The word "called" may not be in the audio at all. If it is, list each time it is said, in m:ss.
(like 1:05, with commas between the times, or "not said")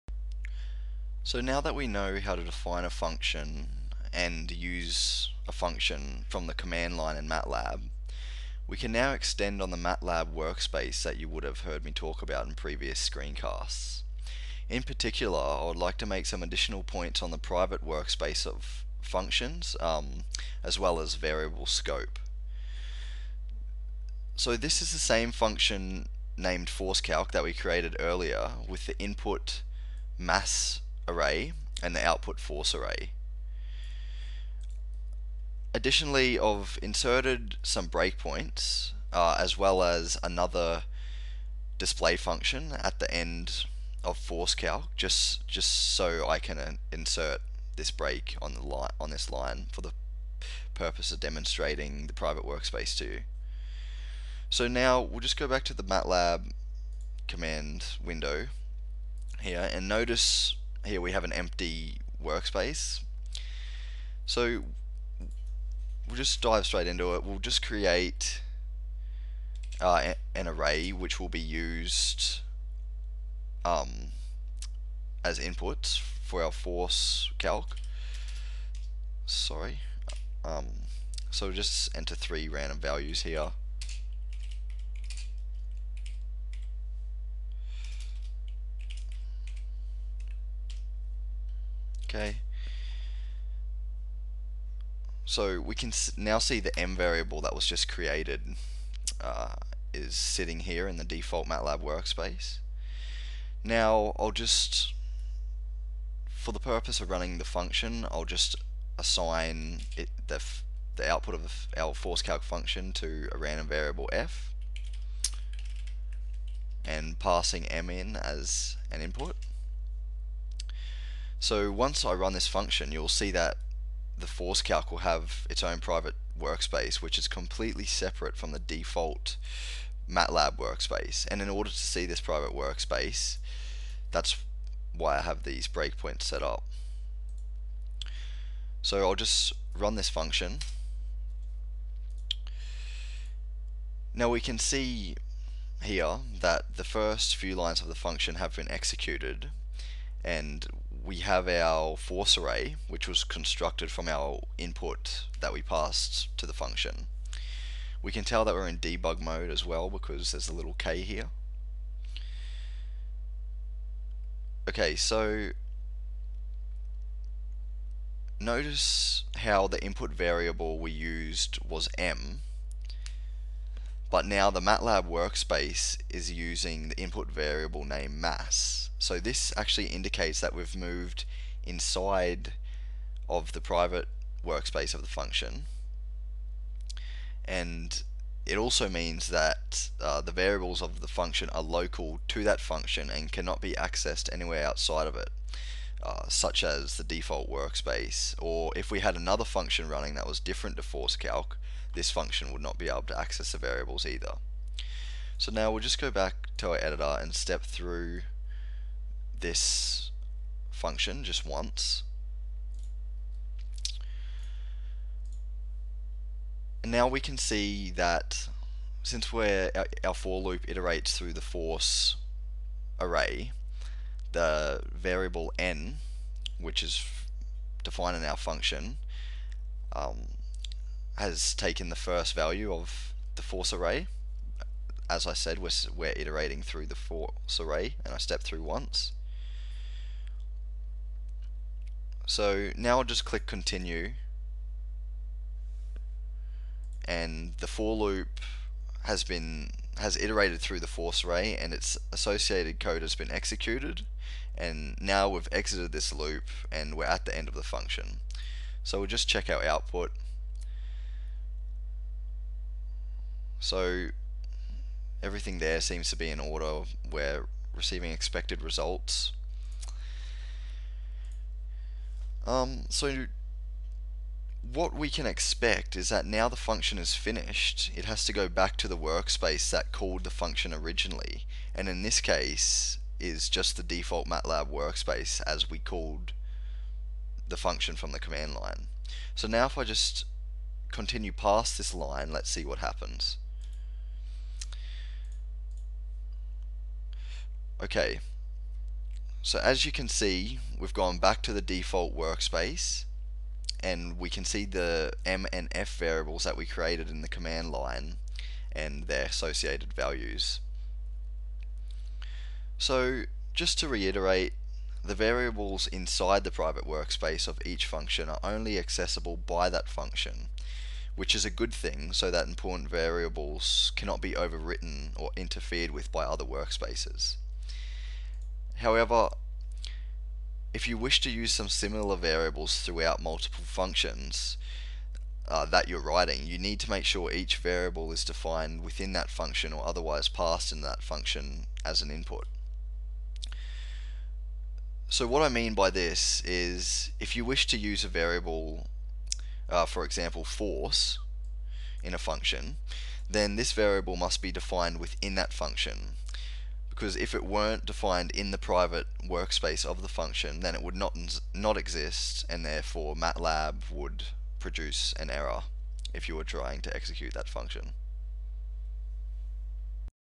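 4:39, 4:45.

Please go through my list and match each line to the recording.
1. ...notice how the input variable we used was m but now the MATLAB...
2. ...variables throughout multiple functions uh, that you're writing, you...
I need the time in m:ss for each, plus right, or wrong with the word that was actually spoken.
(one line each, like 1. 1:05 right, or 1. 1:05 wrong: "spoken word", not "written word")
1. 2:48 right
2. 5:32 right.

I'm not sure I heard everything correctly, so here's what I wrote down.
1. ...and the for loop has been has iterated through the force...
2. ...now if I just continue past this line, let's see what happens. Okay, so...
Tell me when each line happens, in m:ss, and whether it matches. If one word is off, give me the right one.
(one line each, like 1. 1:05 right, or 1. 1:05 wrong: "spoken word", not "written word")
1. 4:07 right
2. 4:49 right.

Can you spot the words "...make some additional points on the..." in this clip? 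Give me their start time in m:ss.
0:16.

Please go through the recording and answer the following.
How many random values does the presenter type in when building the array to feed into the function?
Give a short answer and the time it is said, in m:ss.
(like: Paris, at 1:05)
3, at 1:22.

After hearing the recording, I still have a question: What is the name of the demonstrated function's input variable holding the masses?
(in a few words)
mass array.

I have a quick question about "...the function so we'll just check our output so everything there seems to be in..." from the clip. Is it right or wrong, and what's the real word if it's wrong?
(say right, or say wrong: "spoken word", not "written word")
right.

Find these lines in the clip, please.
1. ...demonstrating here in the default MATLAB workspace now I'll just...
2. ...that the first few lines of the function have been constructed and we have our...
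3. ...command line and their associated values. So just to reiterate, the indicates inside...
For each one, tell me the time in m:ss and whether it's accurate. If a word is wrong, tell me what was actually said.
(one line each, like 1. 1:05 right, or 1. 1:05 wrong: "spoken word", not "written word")
1. 1:40 wrong: "sitting", not "demonstrating"
2. 2:26 wrong: "executed", not "constructed"
3. 5:07 wrong: "variables", not "indicates".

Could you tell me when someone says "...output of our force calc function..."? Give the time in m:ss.
1:51.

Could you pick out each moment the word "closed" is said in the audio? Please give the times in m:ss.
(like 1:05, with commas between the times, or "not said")
not said.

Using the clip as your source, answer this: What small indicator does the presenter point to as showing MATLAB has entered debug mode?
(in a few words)
a little k.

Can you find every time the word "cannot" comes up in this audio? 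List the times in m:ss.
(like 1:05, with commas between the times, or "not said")
3:13, 5:23.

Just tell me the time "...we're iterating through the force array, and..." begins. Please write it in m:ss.
3:55.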